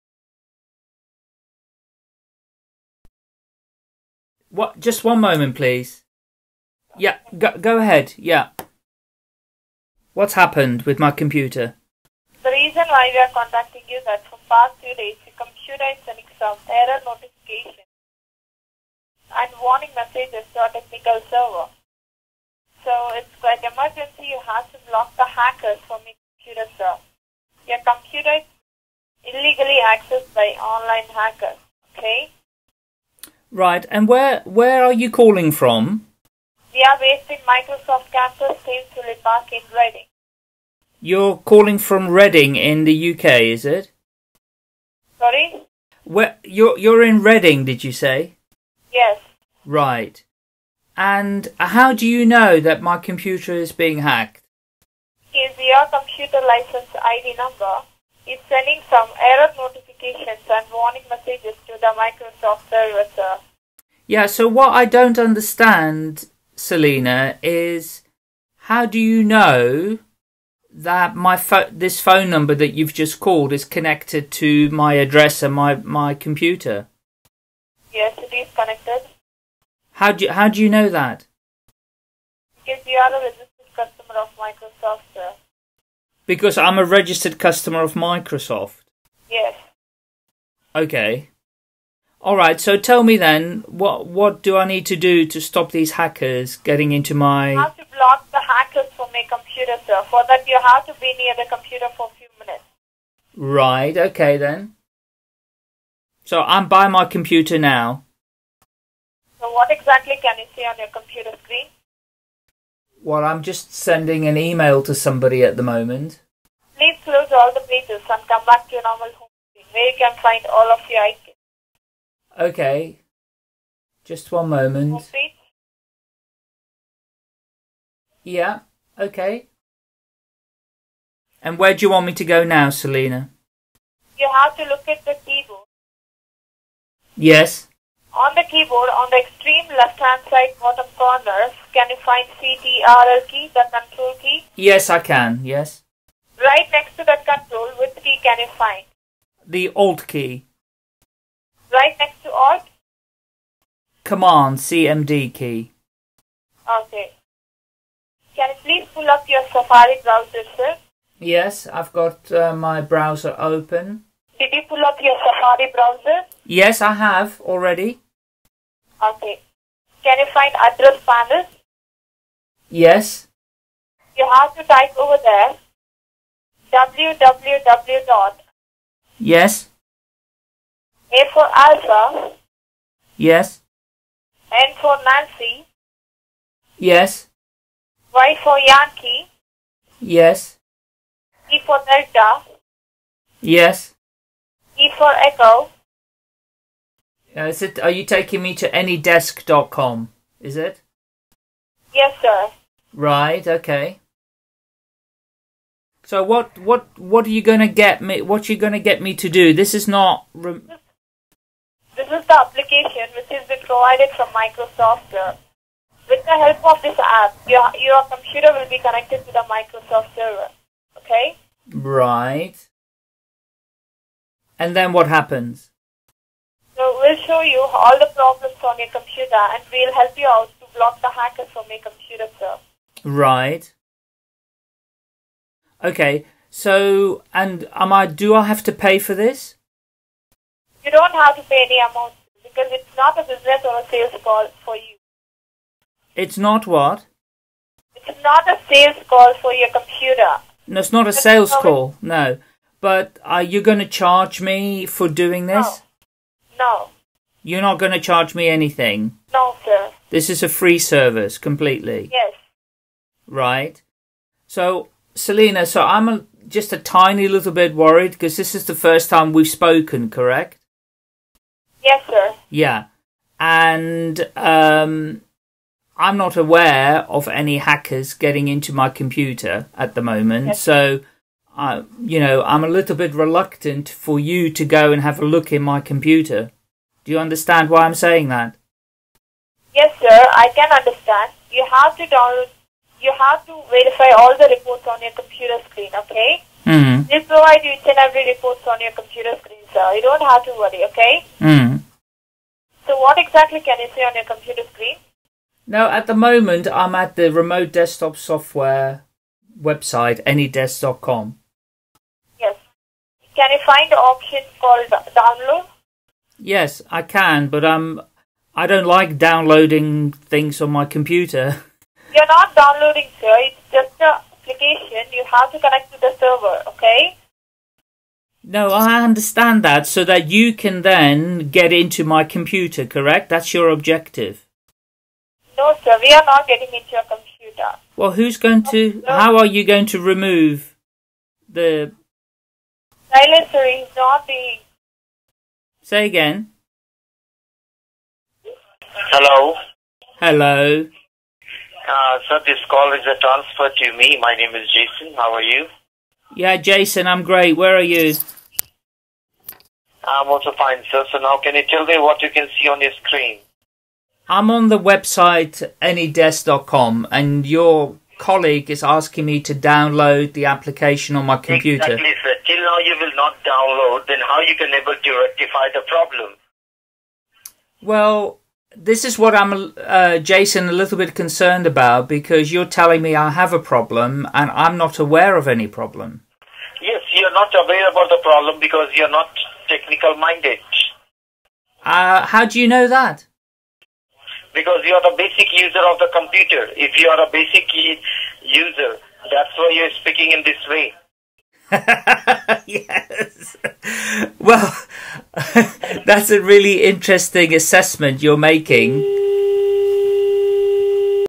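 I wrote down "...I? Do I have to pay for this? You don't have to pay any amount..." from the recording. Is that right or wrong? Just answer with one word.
right.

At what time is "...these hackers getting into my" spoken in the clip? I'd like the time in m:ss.
1:35.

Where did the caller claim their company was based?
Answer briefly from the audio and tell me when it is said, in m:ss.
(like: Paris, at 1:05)
Thames Park, at 0:38.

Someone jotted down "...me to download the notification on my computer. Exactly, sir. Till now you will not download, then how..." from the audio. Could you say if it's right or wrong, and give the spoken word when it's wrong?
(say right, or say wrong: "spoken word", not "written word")
wrong: "application", not "notification".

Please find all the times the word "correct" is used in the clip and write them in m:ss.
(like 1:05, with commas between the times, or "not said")
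4:30, 5:32.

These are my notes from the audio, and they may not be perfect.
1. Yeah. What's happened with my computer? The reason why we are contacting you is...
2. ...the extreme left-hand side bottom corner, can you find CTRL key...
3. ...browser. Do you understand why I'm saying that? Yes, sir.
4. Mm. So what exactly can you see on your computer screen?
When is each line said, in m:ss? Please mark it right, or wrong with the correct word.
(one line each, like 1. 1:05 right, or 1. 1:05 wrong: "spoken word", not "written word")
1. 0:08 right
2. 2:19 right
3. 4:45 wrong: "computer", not "browser"
4. 5:01 right.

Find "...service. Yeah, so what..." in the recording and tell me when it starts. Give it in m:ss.
1:02.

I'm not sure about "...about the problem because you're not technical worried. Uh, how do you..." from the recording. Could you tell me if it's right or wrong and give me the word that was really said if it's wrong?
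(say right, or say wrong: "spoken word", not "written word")
wrong: "minded", not "worried".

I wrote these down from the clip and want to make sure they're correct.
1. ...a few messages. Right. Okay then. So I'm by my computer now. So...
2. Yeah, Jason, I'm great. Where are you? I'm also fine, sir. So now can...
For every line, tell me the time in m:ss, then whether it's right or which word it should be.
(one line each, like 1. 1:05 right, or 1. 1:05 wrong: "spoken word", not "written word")
1. 1:42 wrong: "minutes", not "messages"
2. 5:56 right.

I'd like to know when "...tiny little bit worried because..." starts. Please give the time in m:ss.
4:26.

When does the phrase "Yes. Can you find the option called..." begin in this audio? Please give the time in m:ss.
5:12.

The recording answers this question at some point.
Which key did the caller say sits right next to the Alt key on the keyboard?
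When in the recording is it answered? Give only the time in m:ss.
2:34.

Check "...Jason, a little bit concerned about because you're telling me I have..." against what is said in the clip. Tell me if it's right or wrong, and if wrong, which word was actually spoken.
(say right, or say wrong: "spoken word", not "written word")
right.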